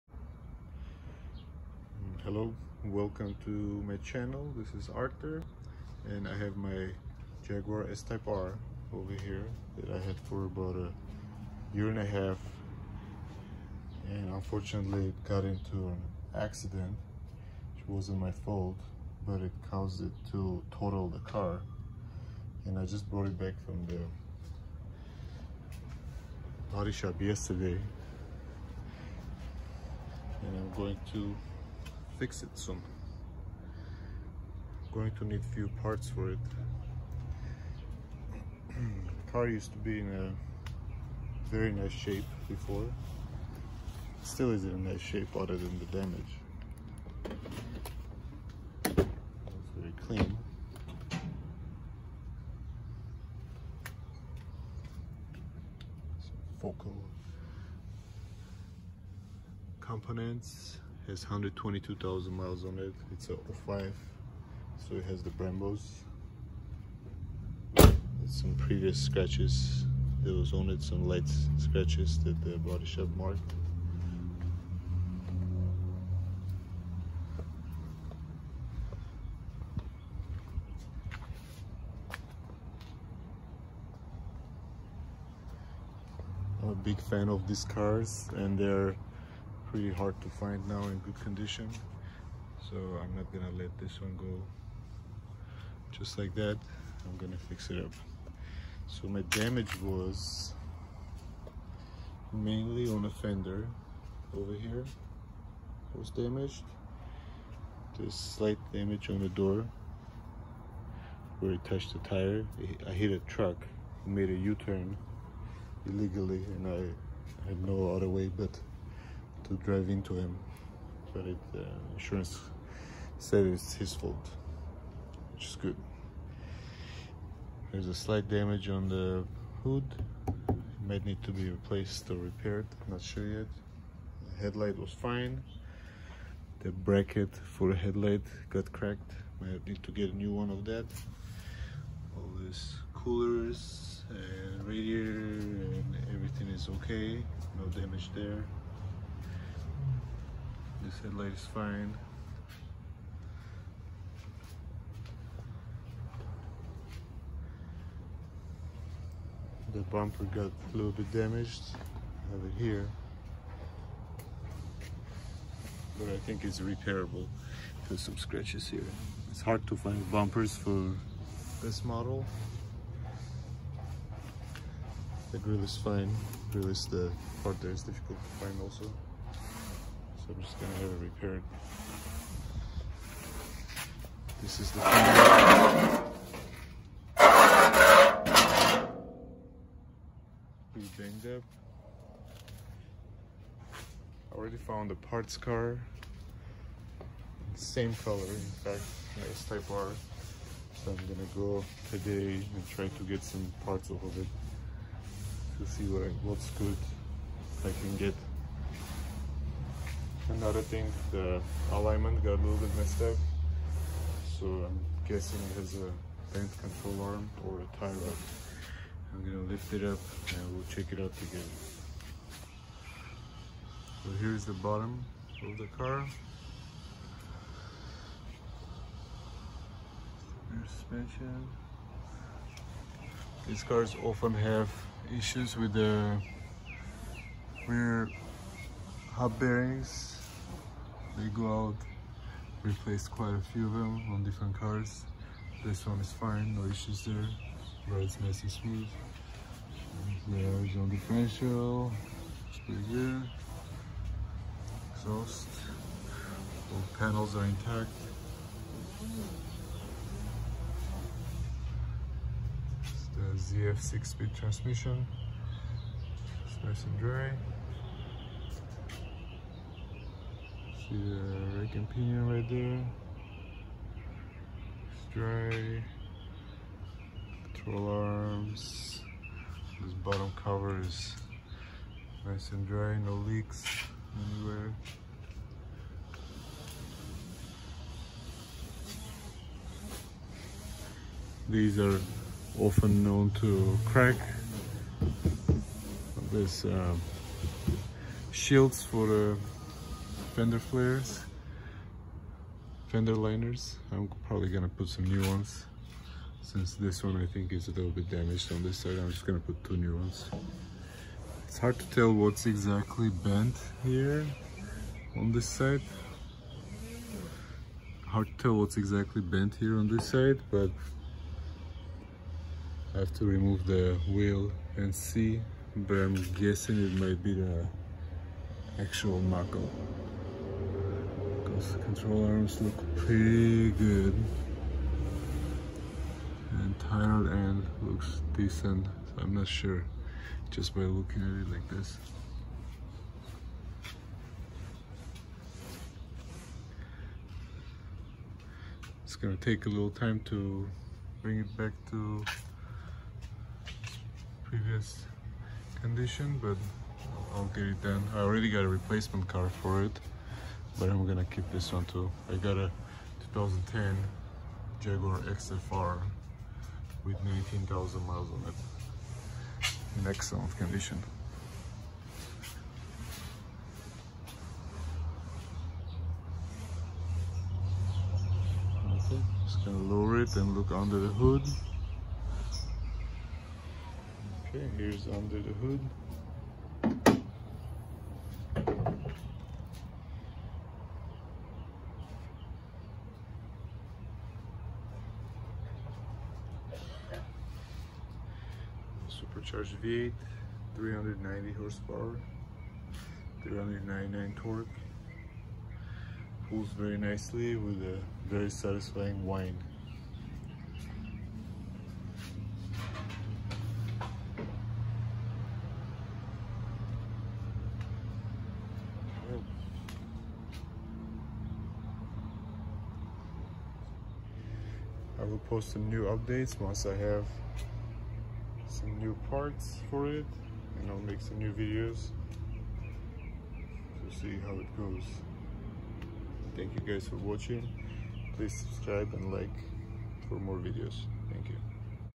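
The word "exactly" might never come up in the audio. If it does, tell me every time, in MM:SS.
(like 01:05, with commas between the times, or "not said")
05:12, 05:18.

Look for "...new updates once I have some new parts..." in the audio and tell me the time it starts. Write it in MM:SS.
07:05.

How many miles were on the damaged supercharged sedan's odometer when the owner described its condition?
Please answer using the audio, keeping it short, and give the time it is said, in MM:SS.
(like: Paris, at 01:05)
122,000, at 01:01.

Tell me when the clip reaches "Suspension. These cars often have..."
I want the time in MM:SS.
03:50.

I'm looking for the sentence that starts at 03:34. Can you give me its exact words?
So I'm guessing it has a bent control arm or a tie rod.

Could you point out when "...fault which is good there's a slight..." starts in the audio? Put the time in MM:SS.
02:03.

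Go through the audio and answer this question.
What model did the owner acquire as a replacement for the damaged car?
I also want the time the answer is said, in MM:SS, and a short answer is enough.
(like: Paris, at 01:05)
Jaguar XFR, at 06:04.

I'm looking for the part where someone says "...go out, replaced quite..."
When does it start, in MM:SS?
04:01.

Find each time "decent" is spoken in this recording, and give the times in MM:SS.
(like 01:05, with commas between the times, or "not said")
05:38.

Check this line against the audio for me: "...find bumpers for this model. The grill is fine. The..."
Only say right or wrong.
right.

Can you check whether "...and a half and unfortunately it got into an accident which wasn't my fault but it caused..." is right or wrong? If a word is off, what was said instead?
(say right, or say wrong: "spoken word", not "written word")
right.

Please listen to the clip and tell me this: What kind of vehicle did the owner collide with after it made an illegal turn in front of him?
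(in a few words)
A truck.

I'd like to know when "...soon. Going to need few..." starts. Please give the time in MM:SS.
00:32.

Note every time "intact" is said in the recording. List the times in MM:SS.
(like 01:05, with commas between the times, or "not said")
04:17.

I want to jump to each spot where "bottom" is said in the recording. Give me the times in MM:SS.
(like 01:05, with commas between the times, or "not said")
03:44, 04:39.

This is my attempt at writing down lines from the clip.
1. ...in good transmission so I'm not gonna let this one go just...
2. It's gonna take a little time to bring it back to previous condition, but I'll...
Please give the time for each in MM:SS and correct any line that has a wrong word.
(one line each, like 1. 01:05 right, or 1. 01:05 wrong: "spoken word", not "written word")
1. 01:30 wrong: "condition", not "transmission"
2. 05:49 right.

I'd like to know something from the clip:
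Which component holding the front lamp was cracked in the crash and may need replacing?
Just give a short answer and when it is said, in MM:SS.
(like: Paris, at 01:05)
The bracket, at 02:16.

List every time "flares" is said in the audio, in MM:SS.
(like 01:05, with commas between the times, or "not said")
05:00.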